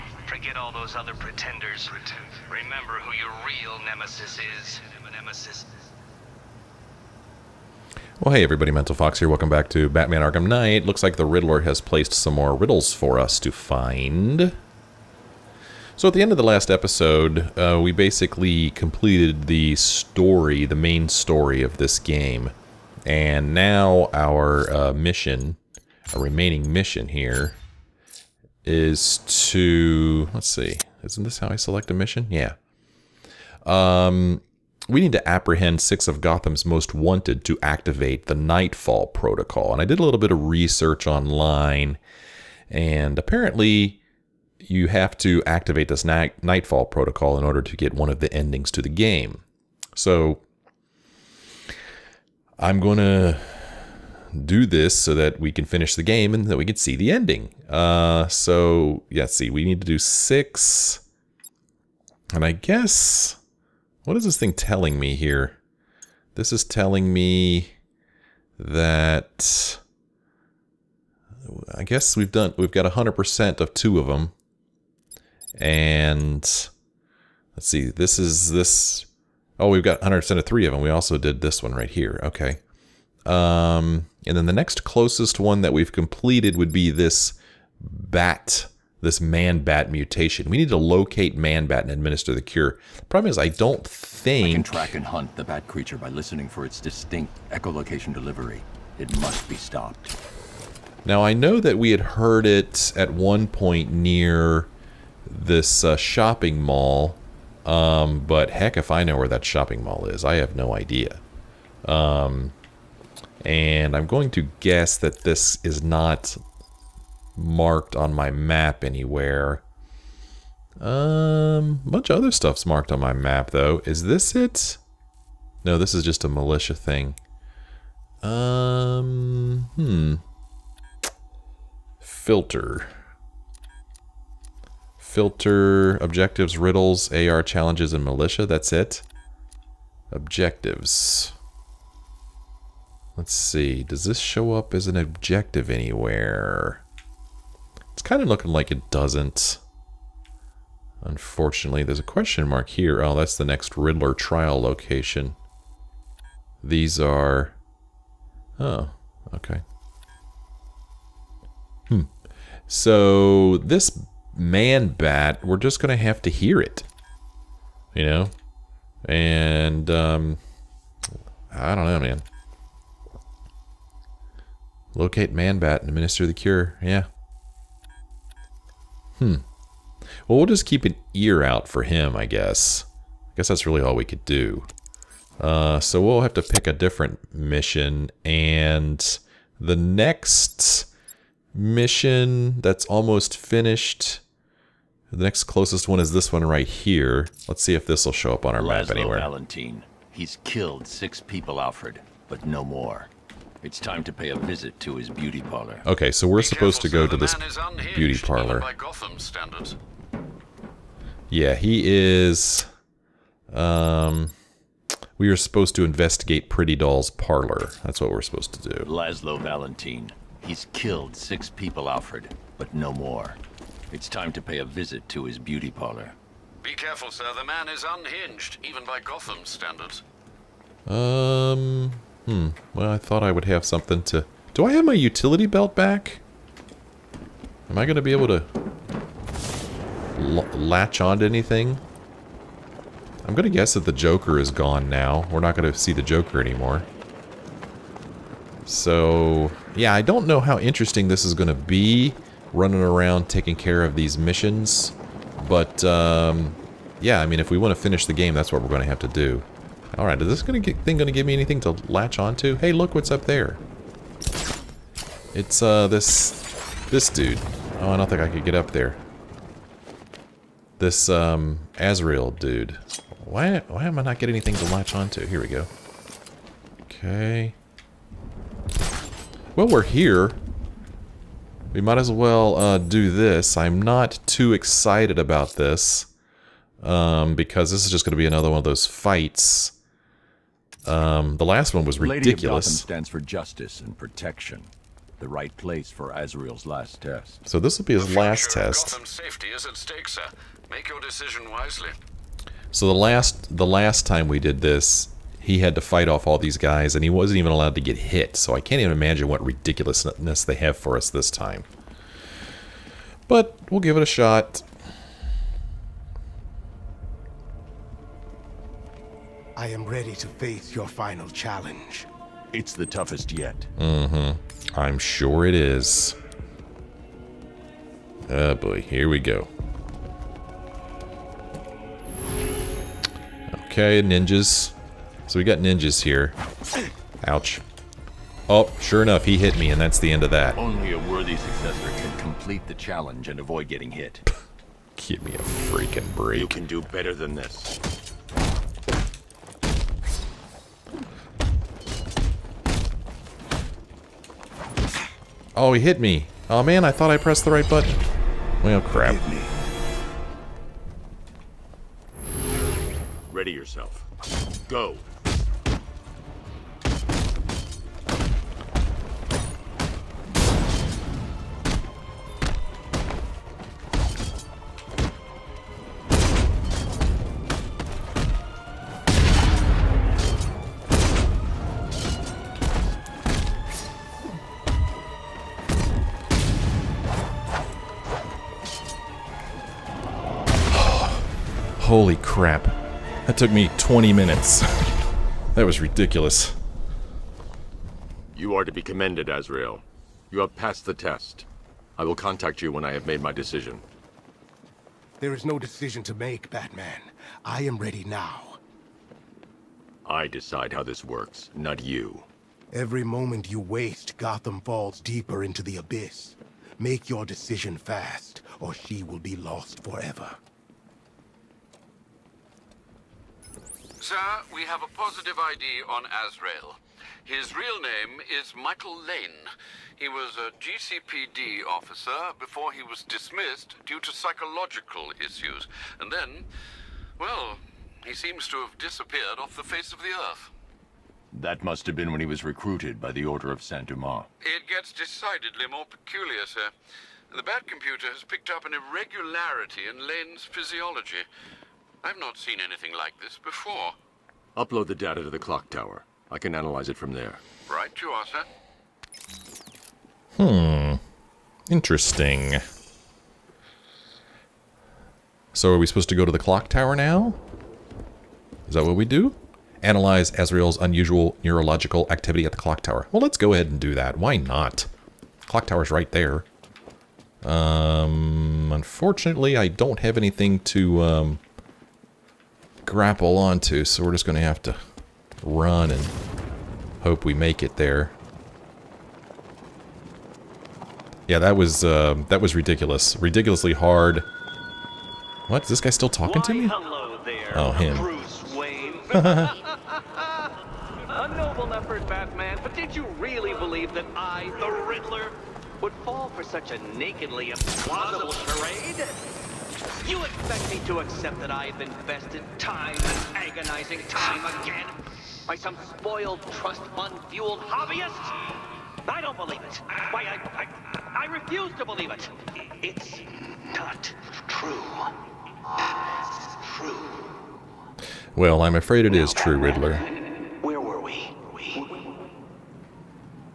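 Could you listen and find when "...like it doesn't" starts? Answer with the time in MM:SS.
02:28.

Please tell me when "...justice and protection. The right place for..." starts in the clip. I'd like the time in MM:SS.
04:53.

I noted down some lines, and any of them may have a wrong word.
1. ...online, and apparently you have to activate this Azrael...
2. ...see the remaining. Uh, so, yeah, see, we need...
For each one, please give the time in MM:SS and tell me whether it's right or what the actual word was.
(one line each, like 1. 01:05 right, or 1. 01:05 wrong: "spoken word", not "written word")
1. 00:41 wrong: "Nightfall", not "Azrael"
2. 00:56 wrong: "ending", not "remaining".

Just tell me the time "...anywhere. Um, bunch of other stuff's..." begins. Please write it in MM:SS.
01:58.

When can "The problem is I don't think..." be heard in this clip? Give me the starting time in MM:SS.
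01:32.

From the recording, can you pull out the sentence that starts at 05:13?
But we'll give it a shot.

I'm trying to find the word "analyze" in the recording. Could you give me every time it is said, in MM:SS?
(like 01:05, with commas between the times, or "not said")
07:36, 07:49.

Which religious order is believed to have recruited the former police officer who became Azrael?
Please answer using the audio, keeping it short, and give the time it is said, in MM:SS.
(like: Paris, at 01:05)
Order of Saint-Dumas, at 07:23.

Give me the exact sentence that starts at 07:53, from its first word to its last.
Well, let's go ahead and do that.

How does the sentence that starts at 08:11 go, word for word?
Yeah, that was uh, that was ridiculous.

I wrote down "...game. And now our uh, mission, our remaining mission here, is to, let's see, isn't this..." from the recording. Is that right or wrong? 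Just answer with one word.
right.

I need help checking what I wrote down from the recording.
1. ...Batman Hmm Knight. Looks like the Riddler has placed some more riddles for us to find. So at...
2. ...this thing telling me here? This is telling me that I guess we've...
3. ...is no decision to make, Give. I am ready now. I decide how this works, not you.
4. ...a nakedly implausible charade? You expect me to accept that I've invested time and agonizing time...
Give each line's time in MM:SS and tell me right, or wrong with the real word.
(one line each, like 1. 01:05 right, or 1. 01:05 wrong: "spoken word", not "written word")
1. 00:09 wrong: "Arkham", not "Hmm"
2. 01:04 right
3. 06:45 wrong: "Batman", not "Give"
4. 08:26 right.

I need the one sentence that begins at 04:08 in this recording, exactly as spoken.
So, yeah, I don't know how interesting this is going to be, running around taking care of these missions.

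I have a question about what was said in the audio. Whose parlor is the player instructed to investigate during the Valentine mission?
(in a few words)
Pretty Doll.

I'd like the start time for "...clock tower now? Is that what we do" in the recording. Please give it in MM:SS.
07:46.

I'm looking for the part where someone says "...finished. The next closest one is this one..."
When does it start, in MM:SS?
03:13.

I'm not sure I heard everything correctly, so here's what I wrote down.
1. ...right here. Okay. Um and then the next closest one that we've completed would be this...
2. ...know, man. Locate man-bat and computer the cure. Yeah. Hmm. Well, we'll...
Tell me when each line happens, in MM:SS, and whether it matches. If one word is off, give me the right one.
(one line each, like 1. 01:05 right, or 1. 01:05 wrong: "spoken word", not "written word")
1. 01:21 right
2. 02:51 wrong: "administer", not "computer".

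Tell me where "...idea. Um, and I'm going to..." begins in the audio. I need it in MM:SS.
01:50.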